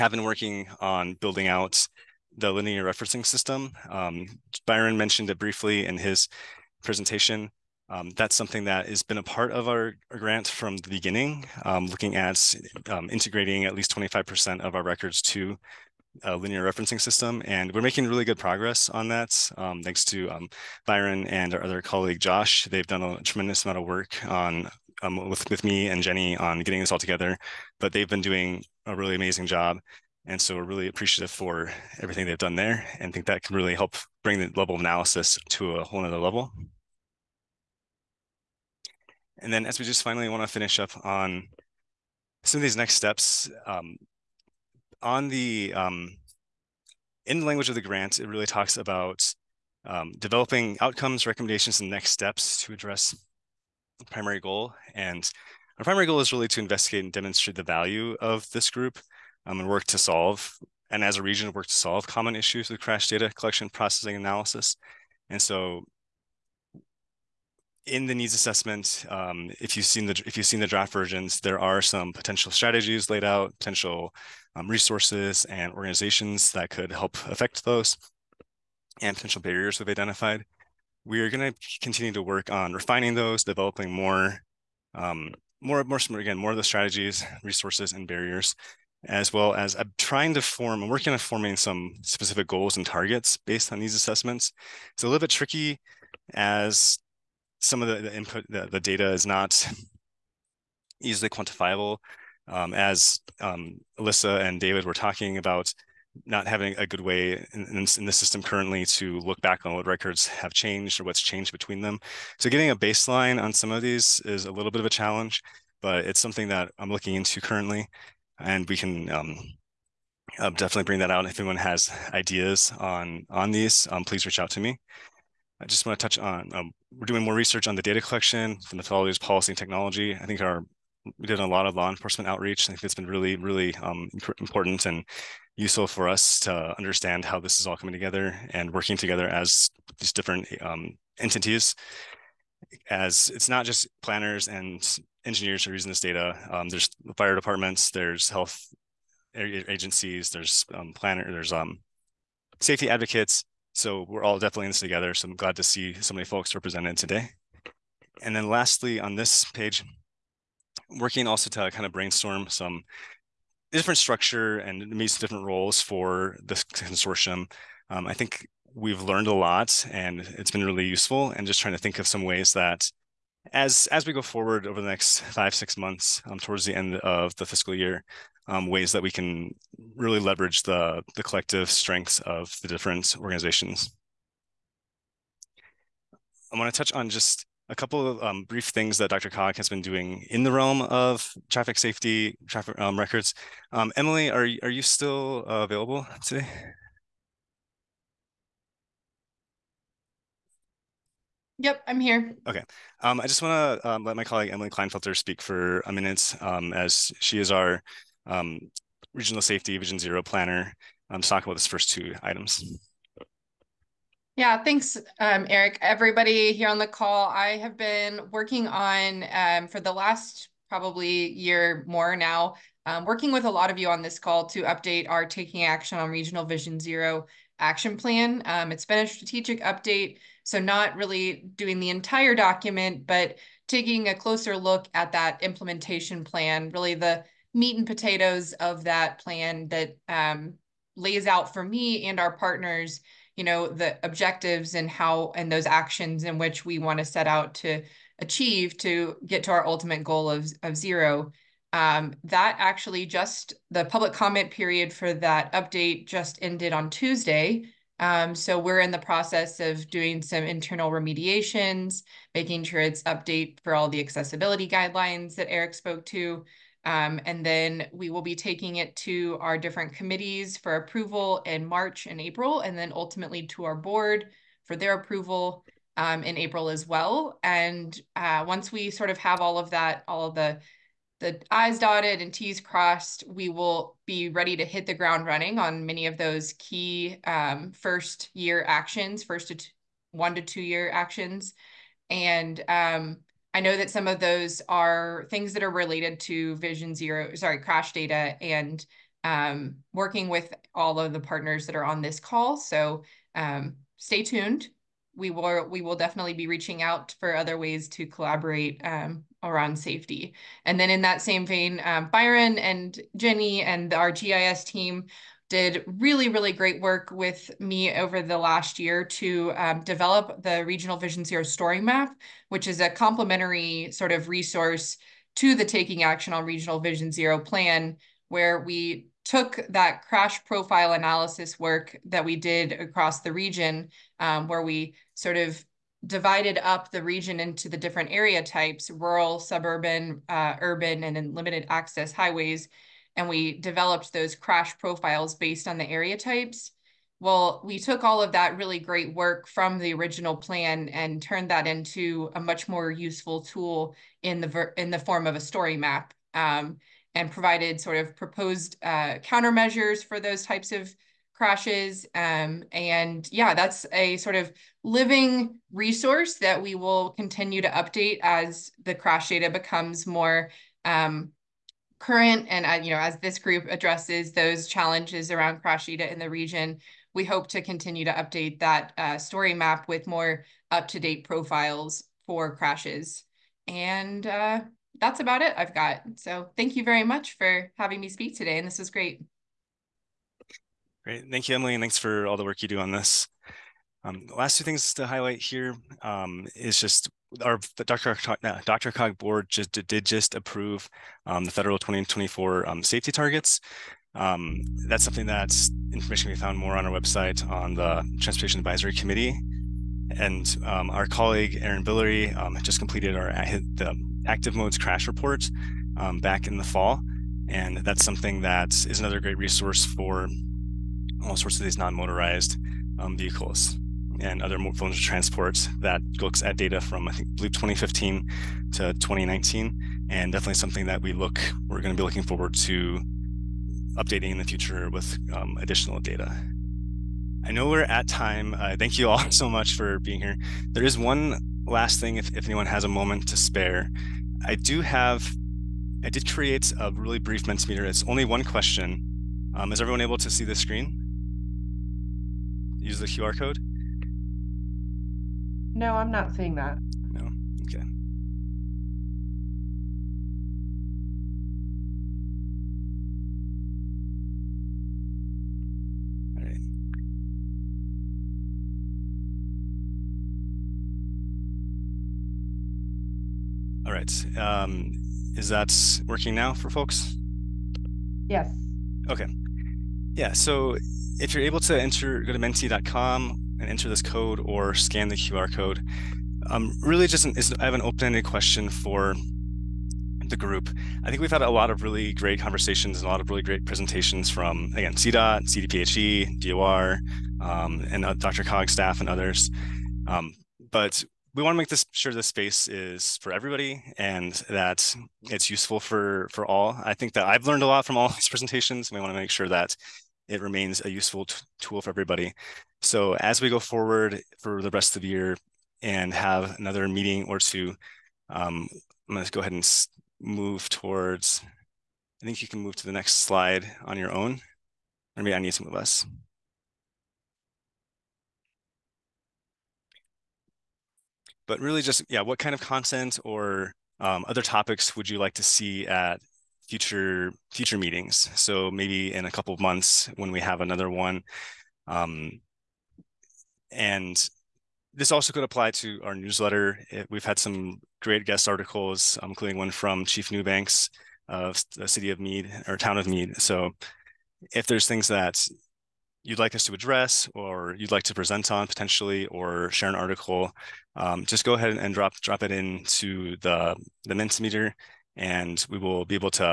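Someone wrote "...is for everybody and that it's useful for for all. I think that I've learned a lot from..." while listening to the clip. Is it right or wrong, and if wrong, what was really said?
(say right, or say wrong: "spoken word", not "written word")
right.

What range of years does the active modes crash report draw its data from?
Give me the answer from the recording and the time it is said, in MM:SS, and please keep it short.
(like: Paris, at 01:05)
2015 to 2019, at 07:07.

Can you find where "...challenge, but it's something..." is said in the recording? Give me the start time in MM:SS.
01:54.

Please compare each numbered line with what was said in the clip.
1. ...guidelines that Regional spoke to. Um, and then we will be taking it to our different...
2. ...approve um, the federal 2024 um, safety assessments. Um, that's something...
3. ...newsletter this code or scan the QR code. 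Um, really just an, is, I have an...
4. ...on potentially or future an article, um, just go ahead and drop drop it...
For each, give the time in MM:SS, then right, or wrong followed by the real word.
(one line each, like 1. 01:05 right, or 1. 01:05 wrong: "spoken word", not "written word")
1. 04:24 wrong: "Eric", not "Regional"
2. 06:40 wrong: "targets", not "assessments"
3. 08:03 wrong: "enter", not "newsletter"
4. 09:18 wrong: "share", not "future".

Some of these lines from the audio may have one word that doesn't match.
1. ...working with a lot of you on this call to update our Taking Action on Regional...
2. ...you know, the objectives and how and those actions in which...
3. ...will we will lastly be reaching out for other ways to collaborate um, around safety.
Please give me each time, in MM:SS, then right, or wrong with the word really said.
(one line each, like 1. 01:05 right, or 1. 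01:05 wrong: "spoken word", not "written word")
1. 03:43 right
2. 04:03 right
3. 05:05 wrong: "definitely", not "lastly".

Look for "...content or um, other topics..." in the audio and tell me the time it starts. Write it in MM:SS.
08:52.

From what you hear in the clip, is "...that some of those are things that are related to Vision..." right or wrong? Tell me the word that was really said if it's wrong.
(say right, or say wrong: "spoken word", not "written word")
right.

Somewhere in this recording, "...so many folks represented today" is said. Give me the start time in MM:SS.
02:36.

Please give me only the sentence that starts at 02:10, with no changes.
I think our we did a lot of law enforcement outreach.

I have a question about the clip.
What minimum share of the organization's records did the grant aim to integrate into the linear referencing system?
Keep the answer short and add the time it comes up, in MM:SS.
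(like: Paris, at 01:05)
25%, at 00:13.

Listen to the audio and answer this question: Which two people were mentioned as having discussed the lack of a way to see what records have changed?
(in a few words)
Alyssa and David.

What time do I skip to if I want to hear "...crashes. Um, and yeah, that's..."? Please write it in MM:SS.
06:01.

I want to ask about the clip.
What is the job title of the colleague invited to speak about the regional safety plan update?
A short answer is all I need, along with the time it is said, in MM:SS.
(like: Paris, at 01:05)
Regional Safety Vision Zero planner, at 03:29.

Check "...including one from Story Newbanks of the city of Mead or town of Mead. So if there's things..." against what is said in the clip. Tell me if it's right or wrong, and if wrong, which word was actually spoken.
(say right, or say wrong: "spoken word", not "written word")
wrong: "Chief", not "Story".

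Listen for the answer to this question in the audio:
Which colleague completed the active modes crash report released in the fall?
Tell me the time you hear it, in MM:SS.
06:51.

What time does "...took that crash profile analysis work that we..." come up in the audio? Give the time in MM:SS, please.
05:29.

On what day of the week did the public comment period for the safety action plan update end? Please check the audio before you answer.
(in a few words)
Tuesday.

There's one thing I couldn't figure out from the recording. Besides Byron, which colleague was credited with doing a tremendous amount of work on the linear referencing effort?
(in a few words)
Josh.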